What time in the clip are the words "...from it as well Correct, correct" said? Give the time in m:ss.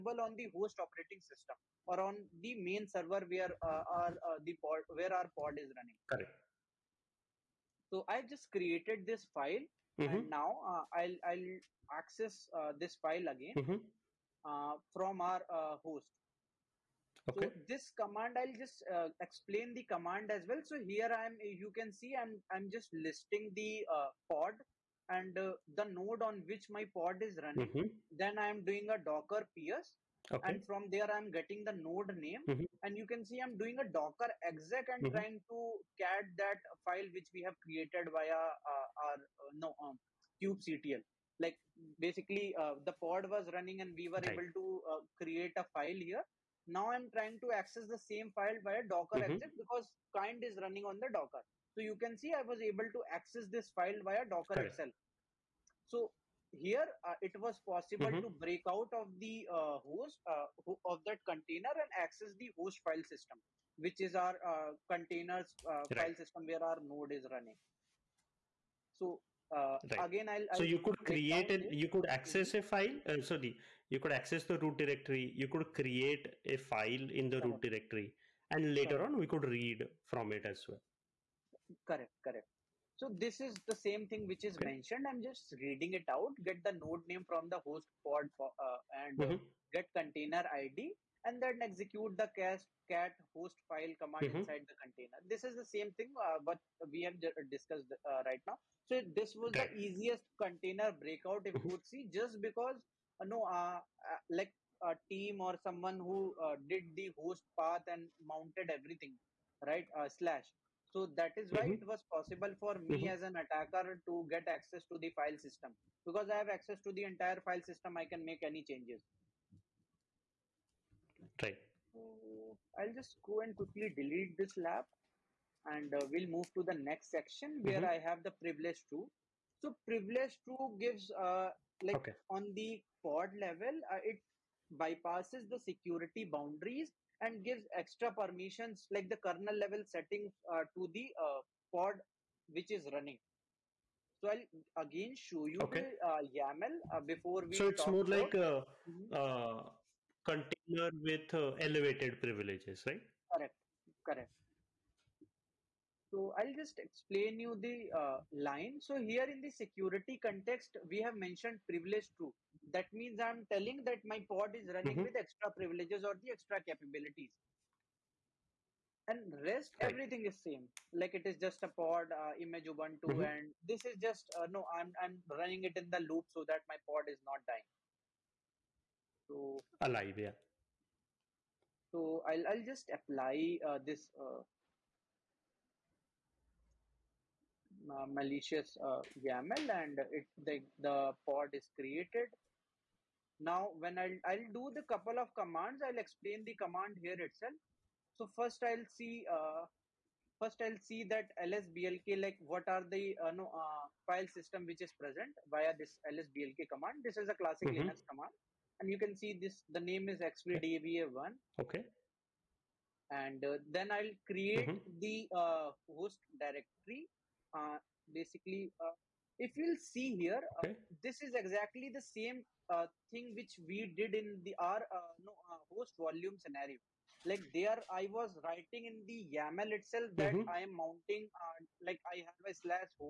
1:20.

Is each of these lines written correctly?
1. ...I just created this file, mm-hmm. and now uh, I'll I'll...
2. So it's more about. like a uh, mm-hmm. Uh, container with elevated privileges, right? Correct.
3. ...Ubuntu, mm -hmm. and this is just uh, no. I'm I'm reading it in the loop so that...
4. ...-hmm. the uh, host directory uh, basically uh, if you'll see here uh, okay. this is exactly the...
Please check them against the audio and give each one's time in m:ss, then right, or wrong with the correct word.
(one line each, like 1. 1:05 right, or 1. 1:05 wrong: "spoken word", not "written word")
1. 0:08 right
2. 2:27 right
3. 2:52 wrong: "running", not "reading"
4. 3:34 right.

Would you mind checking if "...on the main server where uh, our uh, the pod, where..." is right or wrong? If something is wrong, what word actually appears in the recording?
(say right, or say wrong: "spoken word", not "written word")
right.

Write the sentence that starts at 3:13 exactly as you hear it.
Now, when I'll, I'll do the couple of commands, I'll explain the command here itself.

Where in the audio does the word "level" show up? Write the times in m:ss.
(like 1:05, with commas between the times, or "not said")
2:13, 2:19.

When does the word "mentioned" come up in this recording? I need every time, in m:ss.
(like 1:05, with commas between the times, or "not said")
1:24, 2:41.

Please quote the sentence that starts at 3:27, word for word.
This is a classic mm -hmm.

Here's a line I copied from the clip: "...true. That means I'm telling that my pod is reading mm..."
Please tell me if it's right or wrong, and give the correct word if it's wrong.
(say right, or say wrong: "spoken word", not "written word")
wrong: "running", not "reading".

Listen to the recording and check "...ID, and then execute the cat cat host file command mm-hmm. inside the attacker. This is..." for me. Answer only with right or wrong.
wrong.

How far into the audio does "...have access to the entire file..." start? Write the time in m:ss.
1:56.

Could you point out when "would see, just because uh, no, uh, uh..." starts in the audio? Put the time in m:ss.
1:41.